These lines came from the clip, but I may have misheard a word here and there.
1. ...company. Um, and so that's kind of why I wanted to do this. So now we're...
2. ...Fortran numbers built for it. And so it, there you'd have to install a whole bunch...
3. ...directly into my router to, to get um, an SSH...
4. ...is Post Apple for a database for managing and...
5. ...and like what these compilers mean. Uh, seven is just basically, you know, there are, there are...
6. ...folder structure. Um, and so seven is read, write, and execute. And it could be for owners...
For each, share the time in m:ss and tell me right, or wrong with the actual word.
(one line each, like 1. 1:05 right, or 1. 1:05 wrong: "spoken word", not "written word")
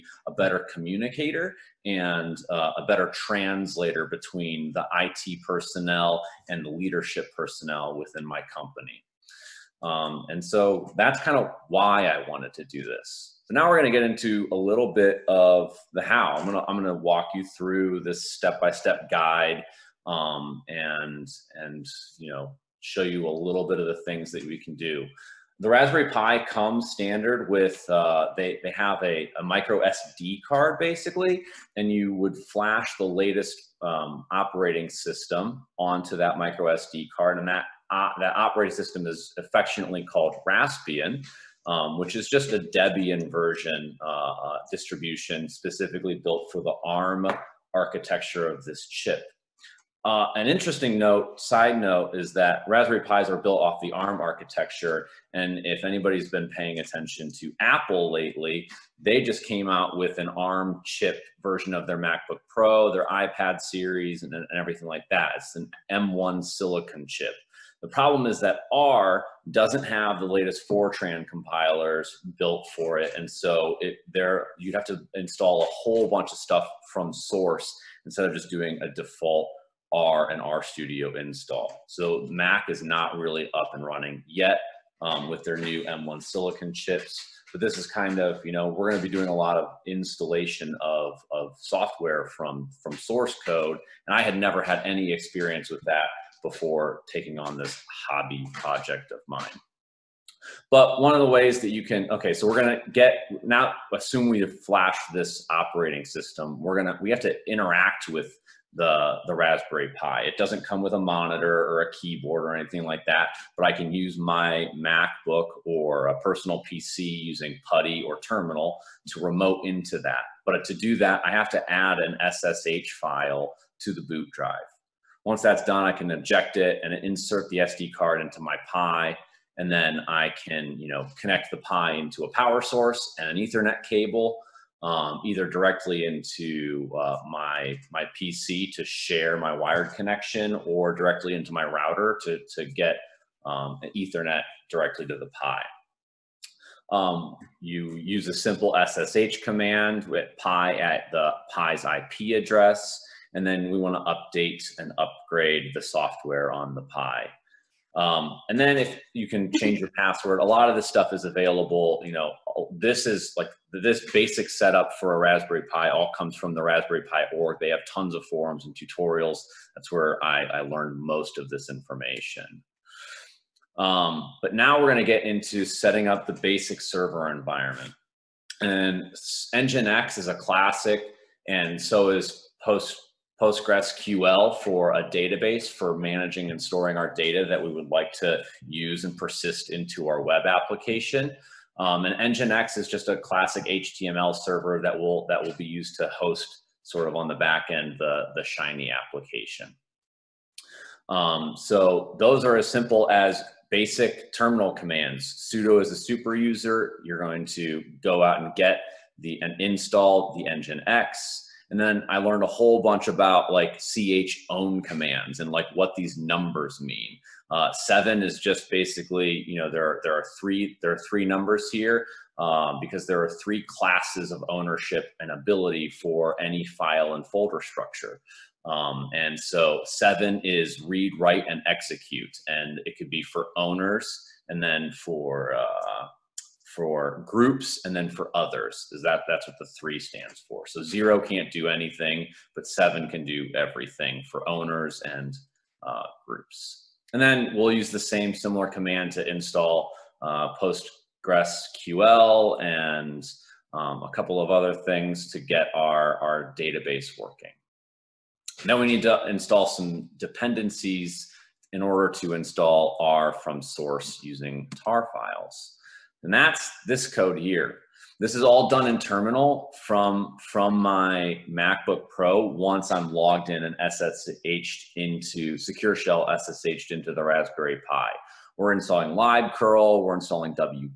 1. 0:08 right
2. 1:10 wrong: "compilers", not "numbers"
3. 2:20 wrong: "Ethernet", not "SSH"
4. 3:02 wrong: "PostgreSQL", not "Apple"
5. 3:35 wrong: "numbers", not "compilers"
6. 3:47 right.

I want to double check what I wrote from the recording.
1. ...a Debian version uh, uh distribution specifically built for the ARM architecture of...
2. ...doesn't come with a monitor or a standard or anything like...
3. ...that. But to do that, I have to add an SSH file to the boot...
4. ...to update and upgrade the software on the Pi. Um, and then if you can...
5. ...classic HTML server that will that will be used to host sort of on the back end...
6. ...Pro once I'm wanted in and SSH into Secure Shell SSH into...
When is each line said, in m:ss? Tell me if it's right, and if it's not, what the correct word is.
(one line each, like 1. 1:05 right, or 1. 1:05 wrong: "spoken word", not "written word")
1. 0:42 right
2. 1:50 wrong: "keyboard", not "standard"
3. 1:59 right
4. 2:33 right
5. 3:13 right
6. 4:32 wrong: "logged", not "wanted".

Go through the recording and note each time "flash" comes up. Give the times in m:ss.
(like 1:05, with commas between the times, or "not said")
0:32, 1:44.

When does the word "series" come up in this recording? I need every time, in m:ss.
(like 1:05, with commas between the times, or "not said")
1:03.